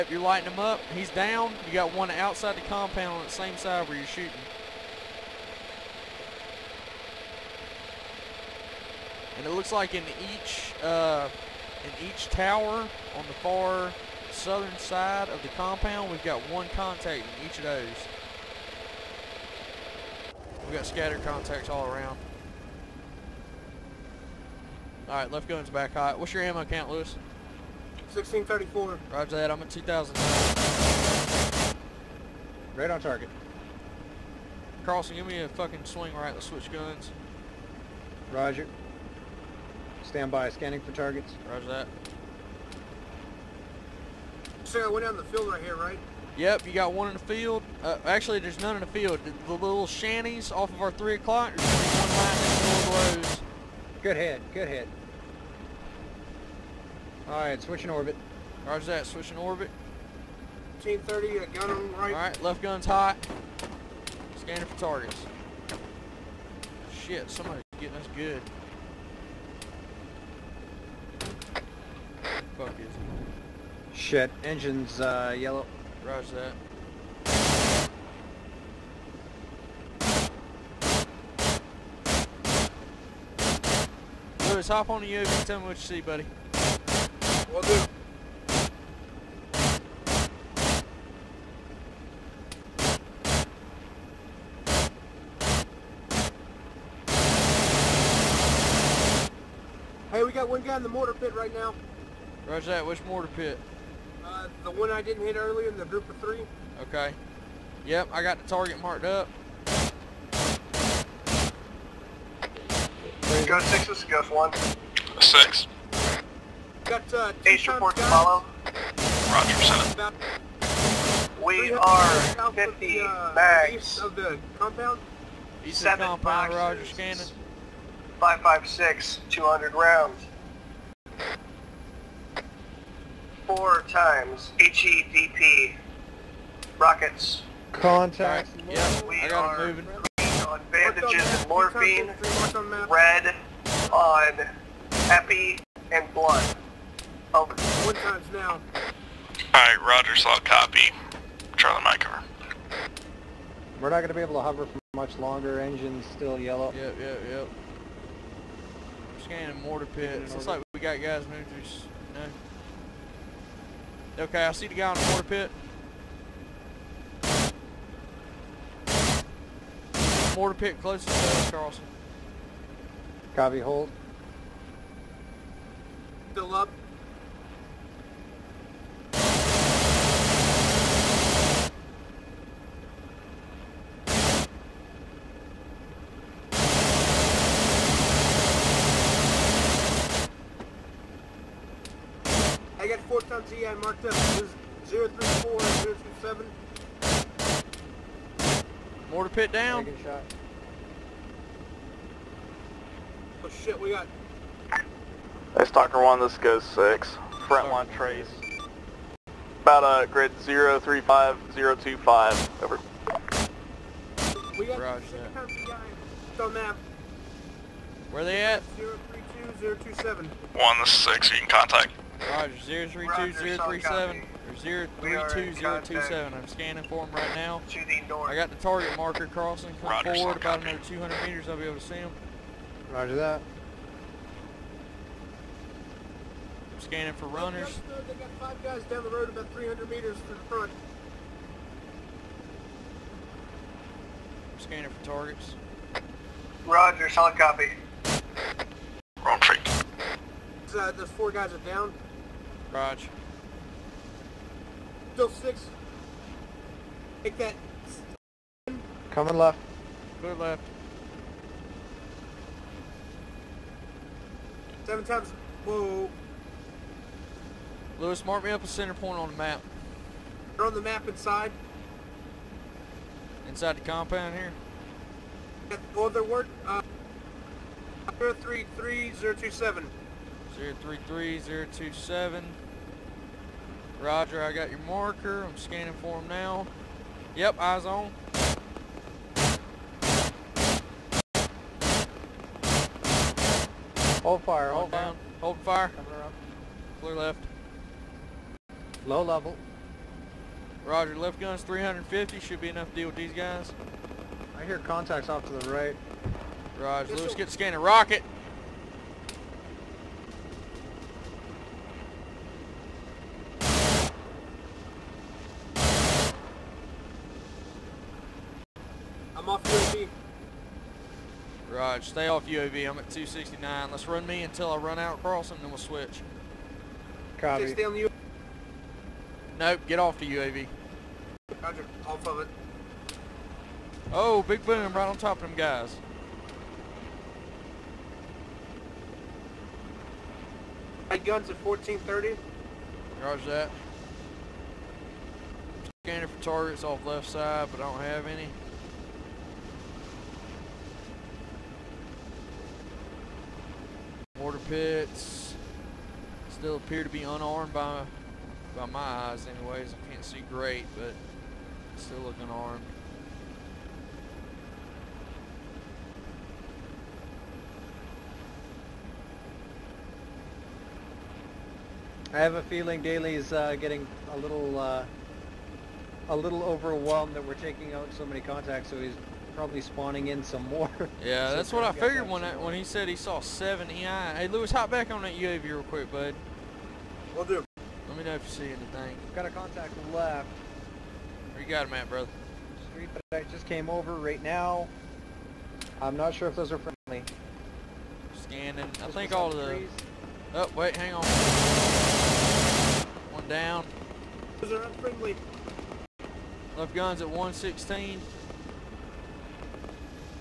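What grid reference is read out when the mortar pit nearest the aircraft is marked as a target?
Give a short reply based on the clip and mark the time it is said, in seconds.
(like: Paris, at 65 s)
034 027, at 194 s.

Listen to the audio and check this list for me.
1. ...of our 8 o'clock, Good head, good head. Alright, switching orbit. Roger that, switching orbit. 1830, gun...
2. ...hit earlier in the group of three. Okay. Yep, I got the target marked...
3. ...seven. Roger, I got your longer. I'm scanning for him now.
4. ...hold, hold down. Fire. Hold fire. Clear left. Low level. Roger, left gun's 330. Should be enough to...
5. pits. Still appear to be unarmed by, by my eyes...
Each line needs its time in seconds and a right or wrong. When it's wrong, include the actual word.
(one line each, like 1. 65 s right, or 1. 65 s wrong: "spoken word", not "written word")
1. 50 s wrong: "3", not "8"
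2. 105 s right
3. 281 s wrong: "marker", not "longer"
4. 294 s wrong: "350", not "330"
5. 354 s right.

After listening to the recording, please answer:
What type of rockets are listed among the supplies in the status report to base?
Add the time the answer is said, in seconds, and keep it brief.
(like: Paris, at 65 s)
HEDP, at 134 s.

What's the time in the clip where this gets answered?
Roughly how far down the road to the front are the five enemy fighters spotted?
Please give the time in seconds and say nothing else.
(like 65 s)
239 s.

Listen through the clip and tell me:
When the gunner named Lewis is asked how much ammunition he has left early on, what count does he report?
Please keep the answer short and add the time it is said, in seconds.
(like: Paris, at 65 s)
1634, at 28 s.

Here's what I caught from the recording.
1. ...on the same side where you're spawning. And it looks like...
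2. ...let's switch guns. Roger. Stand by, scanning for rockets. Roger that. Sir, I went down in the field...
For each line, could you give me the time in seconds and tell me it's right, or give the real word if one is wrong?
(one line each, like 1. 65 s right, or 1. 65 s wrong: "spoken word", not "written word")
1. 3 s wrong: "shooting", not "spawning"
2. 36 s wrong: "targets", not "rockets".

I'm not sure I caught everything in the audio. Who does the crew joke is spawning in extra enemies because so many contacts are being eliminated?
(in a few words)
Daly.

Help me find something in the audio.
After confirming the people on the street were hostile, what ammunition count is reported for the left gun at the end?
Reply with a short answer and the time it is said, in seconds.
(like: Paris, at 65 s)
116, at 407 s.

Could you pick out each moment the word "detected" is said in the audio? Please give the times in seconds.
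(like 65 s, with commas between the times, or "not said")
not said.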